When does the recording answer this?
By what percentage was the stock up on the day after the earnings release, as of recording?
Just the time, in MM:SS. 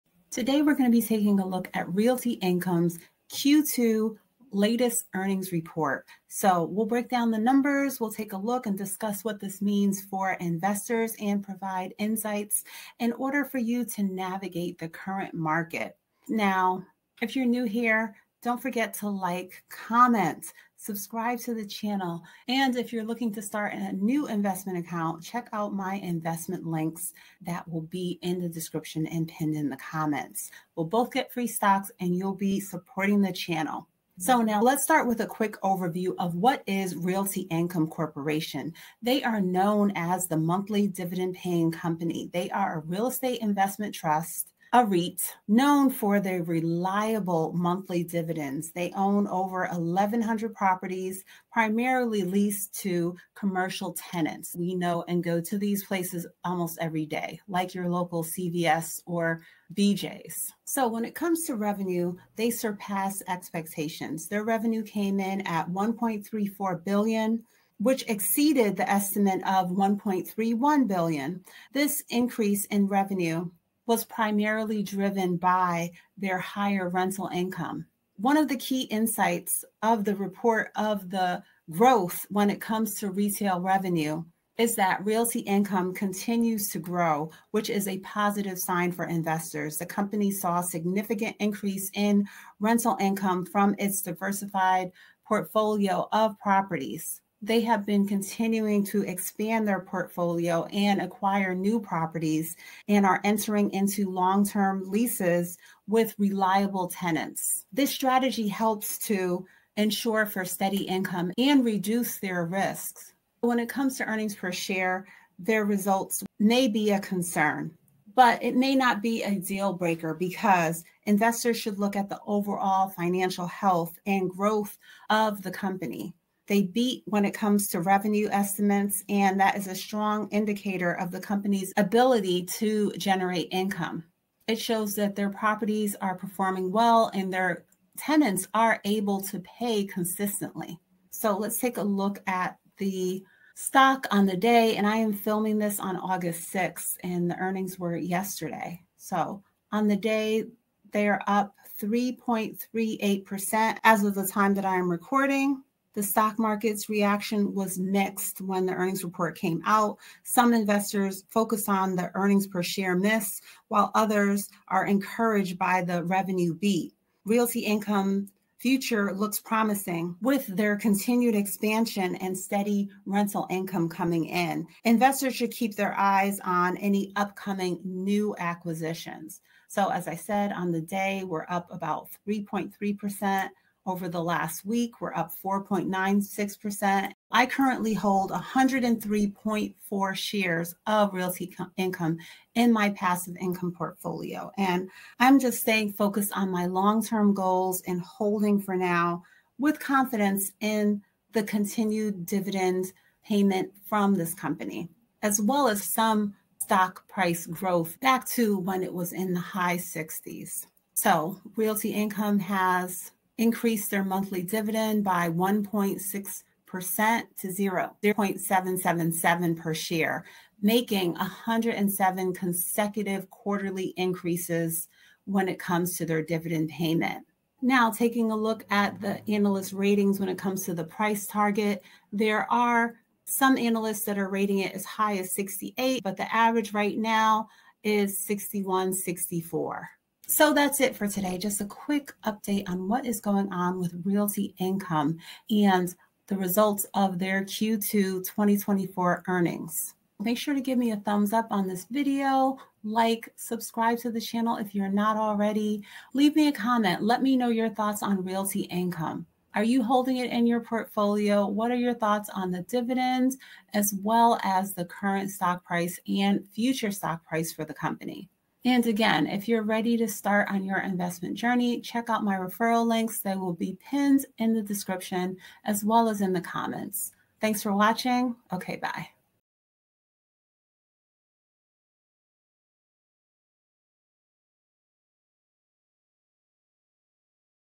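02:31.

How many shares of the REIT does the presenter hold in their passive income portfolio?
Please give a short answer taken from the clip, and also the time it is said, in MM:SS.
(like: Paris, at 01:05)
103.4, at 03:08.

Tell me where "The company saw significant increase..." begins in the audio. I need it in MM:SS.
01:29.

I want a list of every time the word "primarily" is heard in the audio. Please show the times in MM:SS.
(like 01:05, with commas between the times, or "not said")
00:51, 01:14.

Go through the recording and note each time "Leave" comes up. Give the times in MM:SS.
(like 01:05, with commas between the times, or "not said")
04:16.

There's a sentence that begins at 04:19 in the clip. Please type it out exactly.
Are you holding it in your portfolio?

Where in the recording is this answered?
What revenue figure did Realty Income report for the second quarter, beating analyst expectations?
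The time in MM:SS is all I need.
01:05.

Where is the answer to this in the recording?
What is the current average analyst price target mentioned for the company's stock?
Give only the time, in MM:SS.
03:58.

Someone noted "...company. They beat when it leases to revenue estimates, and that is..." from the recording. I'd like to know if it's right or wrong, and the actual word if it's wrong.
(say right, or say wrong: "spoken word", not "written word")
wrong: "comes", not "leases".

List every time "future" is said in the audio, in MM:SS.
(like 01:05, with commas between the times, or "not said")
02:48, 04:26.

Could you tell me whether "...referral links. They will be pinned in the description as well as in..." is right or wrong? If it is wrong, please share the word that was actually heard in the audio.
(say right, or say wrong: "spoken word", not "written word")
right.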